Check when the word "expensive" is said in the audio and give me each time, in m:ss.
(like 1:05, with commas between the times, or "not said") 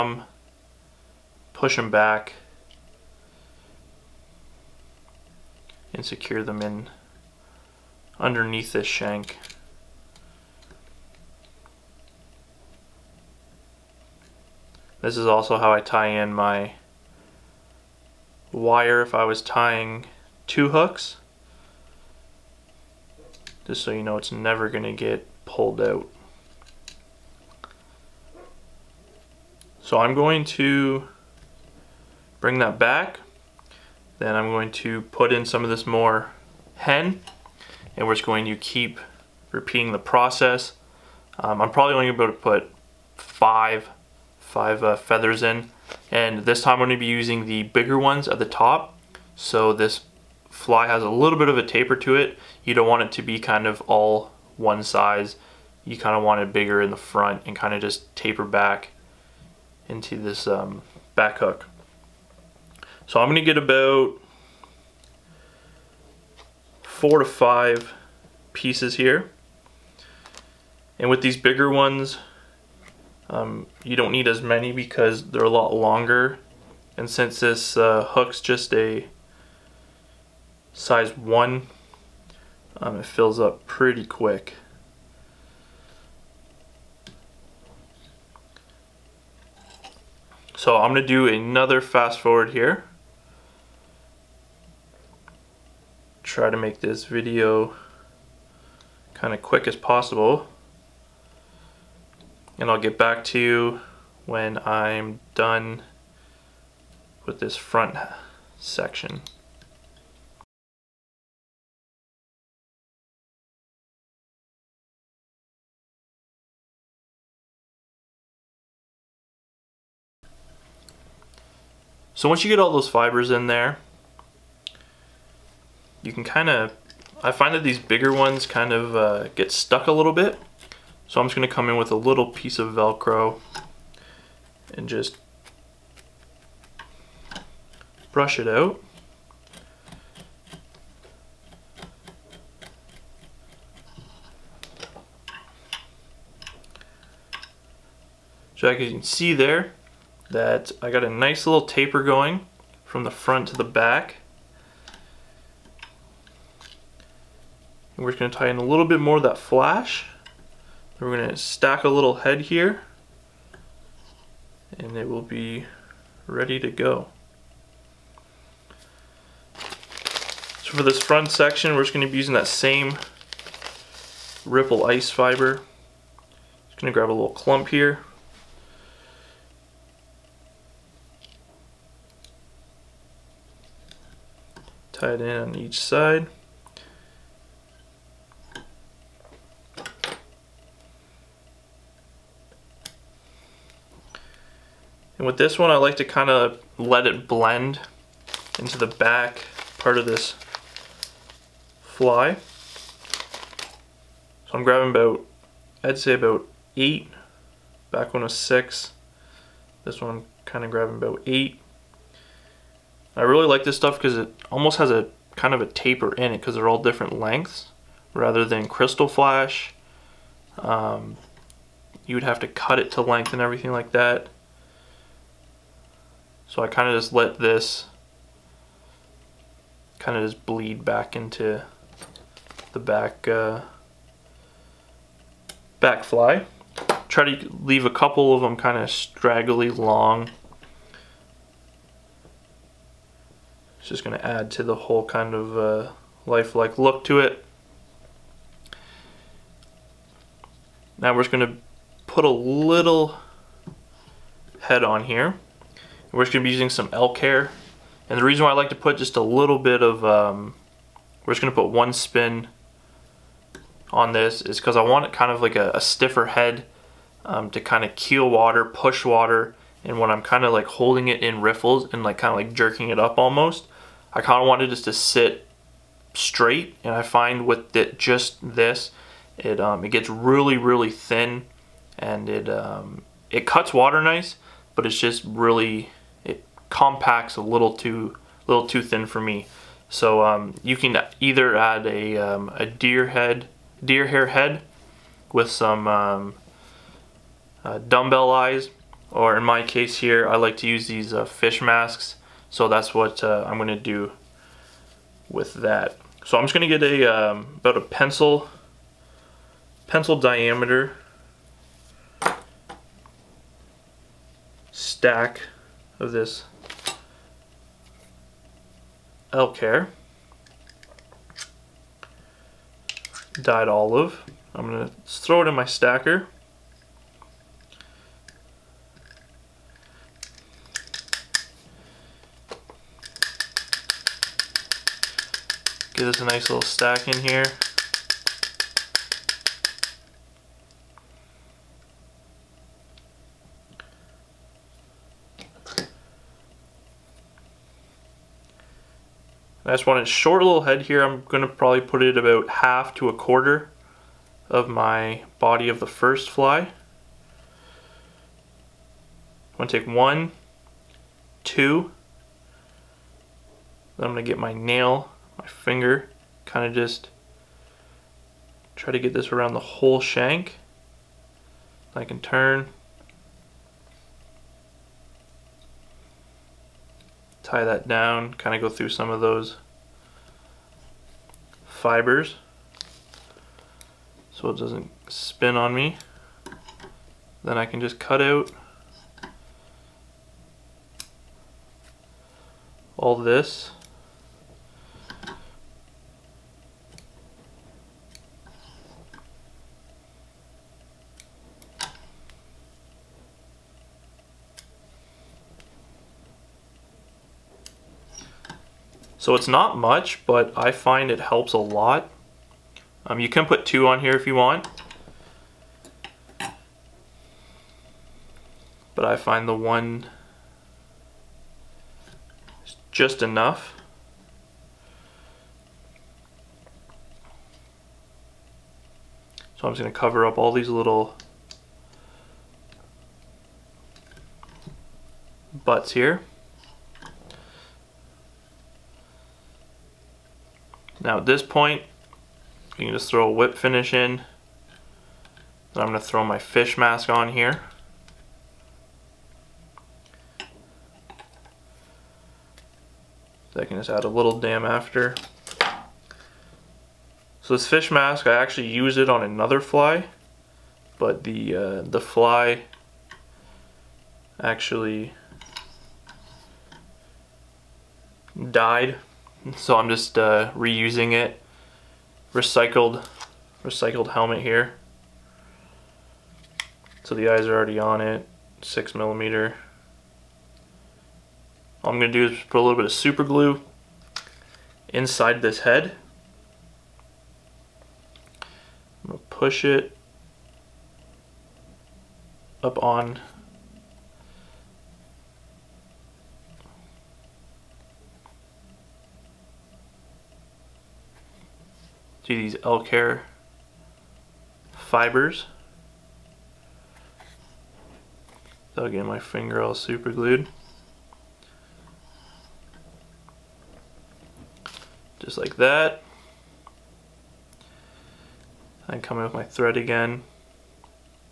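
not said.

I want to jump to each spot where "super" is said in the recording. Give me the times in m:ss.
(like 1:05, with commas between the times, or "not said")
8:02, 8:29.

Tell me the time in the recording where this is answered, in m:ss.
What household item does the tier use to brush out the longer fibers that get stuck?
2:12.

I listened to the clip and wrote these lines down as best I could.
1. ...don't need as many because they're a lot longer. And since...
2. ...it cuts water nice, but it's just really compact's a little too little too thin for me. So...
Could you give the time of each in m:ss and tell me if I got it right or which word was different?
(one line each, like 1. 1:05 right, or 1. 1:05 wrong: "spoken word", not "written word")
1. 1:13 right
2. 4:43 right.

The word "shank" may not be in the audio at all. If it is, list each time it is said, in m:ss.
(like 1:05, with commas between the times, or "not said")
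0:08, 6:10.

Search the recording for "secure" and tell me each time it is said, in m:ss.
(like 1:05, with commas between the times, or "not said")
0:06.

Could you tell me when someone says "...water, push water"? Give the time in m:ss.
4:28.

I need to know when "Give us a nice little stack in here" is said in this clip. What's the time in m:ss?
5:35.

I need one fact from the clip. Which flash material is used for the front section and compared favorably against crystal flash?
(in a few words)
ripple ice fiber.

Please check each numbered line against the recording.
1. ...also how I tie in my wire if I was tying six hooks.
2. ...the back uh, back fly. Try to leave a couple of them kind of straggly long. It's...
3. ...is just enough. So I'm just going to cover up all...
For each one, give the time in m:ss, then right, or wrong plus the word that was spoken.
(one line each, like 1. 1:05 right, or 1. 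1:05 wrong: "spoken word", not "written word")
1. 0:15 wrong: "two", not "six"
2. 3:52 right
3. 7:02 right.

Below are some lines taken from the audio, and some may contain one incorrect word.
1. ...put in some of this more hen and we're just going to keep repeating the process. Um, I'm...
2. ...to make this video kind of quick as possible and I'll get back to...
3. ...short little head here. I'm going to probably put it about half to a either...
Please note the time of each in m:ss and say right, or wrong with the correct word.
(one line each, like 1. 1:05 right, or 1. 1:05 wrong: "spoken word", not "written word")
1. 0:35 right
2. 1:36 right
3. 5:50 wrong: "quarter", not "either".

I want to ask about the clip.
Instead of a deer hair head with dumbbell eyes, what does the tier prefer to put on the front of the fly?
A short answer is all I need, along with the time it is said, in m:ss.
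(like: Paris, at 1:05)
fish masks, at 5:01.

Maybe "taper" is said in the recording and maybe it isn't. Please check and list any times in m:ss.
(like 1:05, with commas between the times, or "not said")
0:51, 0:58, 2:31, 3:35.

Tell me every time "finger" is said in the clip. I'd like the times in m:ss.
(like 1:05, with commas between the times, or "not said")
6:05, 8:29.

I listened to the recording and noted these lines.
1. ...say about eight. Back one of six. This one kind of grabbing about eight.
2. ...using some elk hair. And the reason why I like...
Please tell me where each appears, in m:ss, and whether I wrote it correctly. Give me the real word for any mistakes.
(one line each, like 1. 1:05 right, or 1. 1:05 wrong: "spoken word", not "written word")
1. 3:25 right
2. 4:16 right.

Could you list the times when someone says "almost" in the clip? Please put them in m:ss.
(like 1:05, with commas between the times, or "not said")
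3:34, 4:33.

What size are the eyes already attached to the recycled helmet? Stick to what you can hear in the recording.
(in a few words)
6 millimeter.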